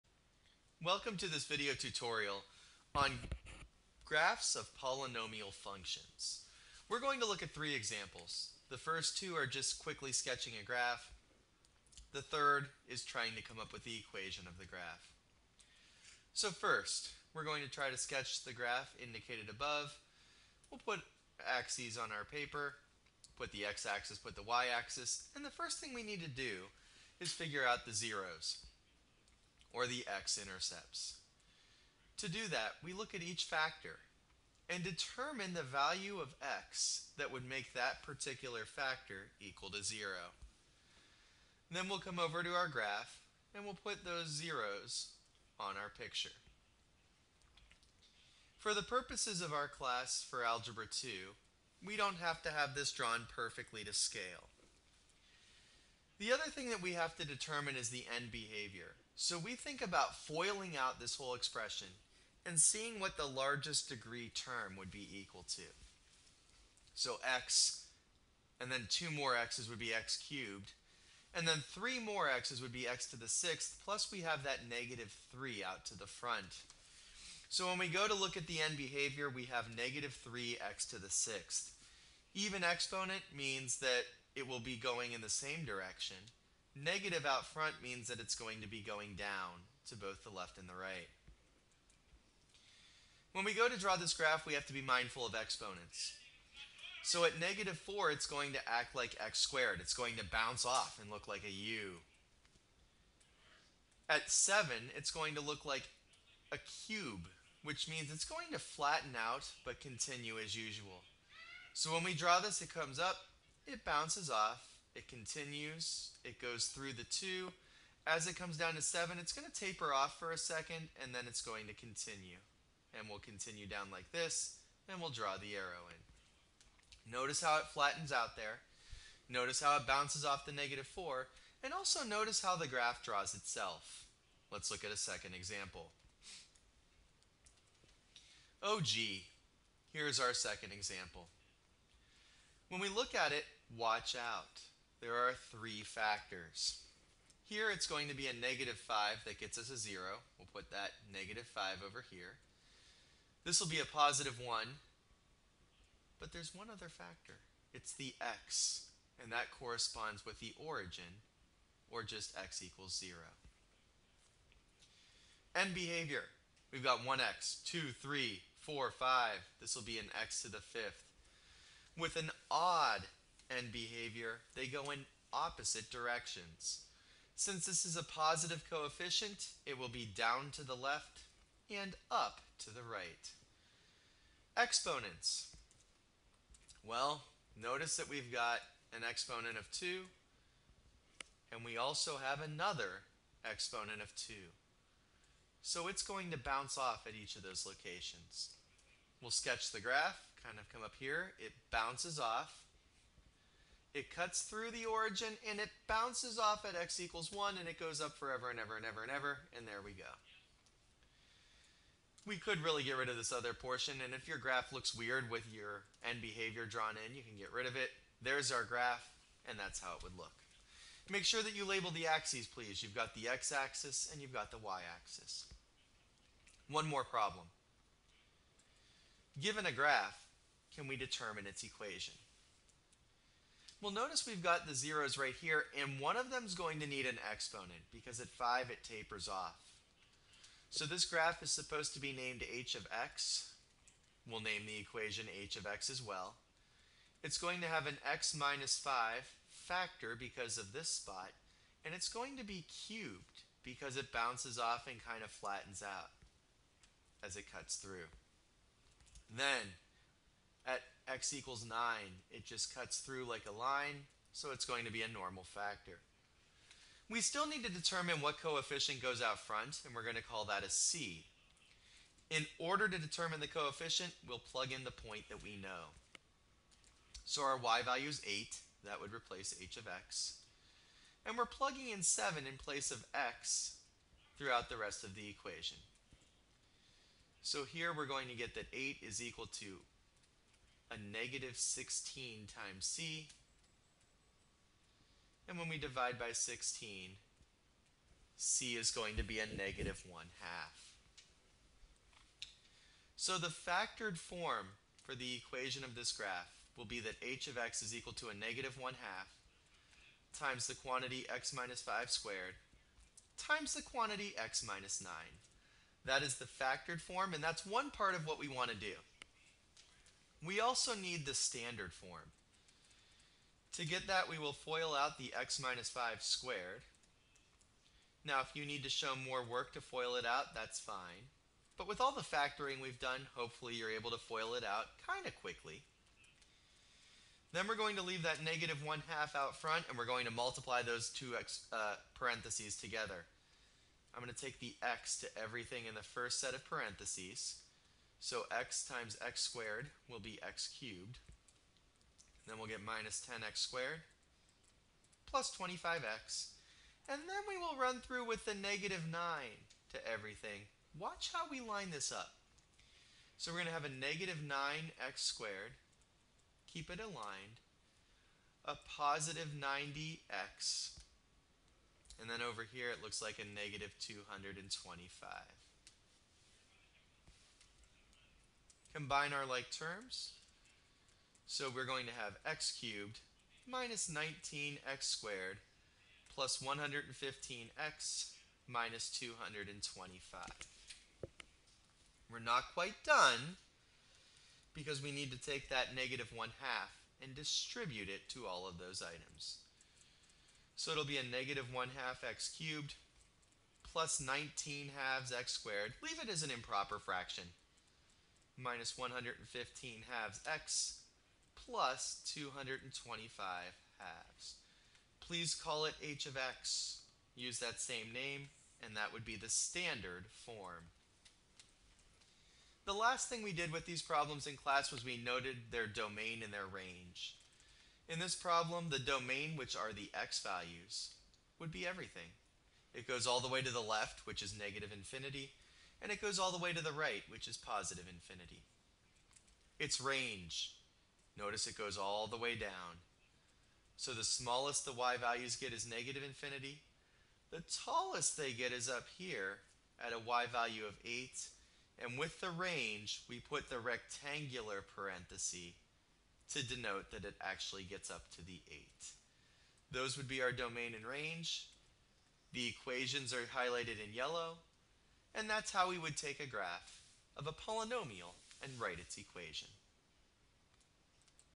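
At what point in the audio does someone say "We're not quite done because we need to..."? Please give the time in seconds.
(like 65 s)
392 s.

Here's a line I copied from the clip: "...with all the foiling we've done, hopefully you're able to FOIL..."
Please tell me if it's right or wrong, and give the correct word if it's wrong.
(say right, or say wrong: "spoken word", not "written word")
wrong: "factoring", not "foiling".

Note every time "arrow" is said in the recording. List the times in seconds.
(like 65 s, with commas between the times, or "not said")
125 s.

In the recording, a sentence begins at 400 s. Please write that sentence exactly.
So it'll be a negative 1 half x cubed plus 19 halves x squared.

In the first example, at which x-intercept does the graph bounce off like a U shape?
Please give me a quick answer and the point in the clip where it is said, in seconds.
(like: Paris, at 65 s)
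-4, at 97 s.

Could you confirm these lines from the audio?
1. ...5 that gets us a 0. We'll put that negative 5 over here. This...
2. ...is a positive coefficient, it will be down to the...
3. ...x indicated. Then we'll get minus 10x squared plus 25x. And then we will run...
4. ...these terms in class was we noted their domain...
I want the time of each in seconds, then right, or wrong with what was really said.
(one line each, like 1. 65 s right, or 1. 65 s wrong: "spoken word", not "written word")
1. 148 s right
2. 177 s right
3. 350 s wrong: "cubed", not "indicated"
4. 423 s wrong: "problems", not "terms".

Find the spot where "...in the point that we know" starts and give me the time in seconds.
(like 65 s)
274 s.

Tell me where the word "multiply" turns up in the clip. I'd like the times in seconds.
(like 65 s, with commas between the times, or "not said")
340 s.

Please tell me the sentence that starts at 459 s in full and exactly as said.
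Those would be our domain and range.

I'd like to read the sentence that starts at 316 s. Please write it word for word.
That is the factored form, and that's one part of what we want to do.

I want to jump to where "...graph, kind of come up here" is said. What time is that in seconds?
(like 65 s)
199 s.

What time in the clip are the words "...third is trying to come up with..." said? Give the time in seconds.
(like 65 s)
12 s.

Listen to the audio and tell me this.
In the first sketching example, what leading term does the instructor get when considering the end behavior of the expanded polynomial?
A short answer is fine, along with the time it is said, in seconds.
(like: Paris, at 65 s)
-3x^6, at 79 s.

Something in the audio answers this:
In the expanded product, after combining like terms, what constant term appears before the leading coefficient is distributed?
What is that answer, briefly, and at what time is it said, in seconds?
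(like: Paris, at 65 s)
-225, at 388 s.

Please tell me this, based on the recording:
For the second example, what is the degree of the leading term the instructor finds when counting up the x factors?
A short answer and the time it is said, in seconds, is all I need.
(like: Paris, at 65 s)
5, at 170 s.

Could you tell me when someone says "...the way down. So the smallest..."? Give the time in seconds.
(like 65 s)
442 s.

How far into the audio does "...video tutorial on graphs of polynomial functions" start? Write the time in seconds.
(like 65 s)
1 s.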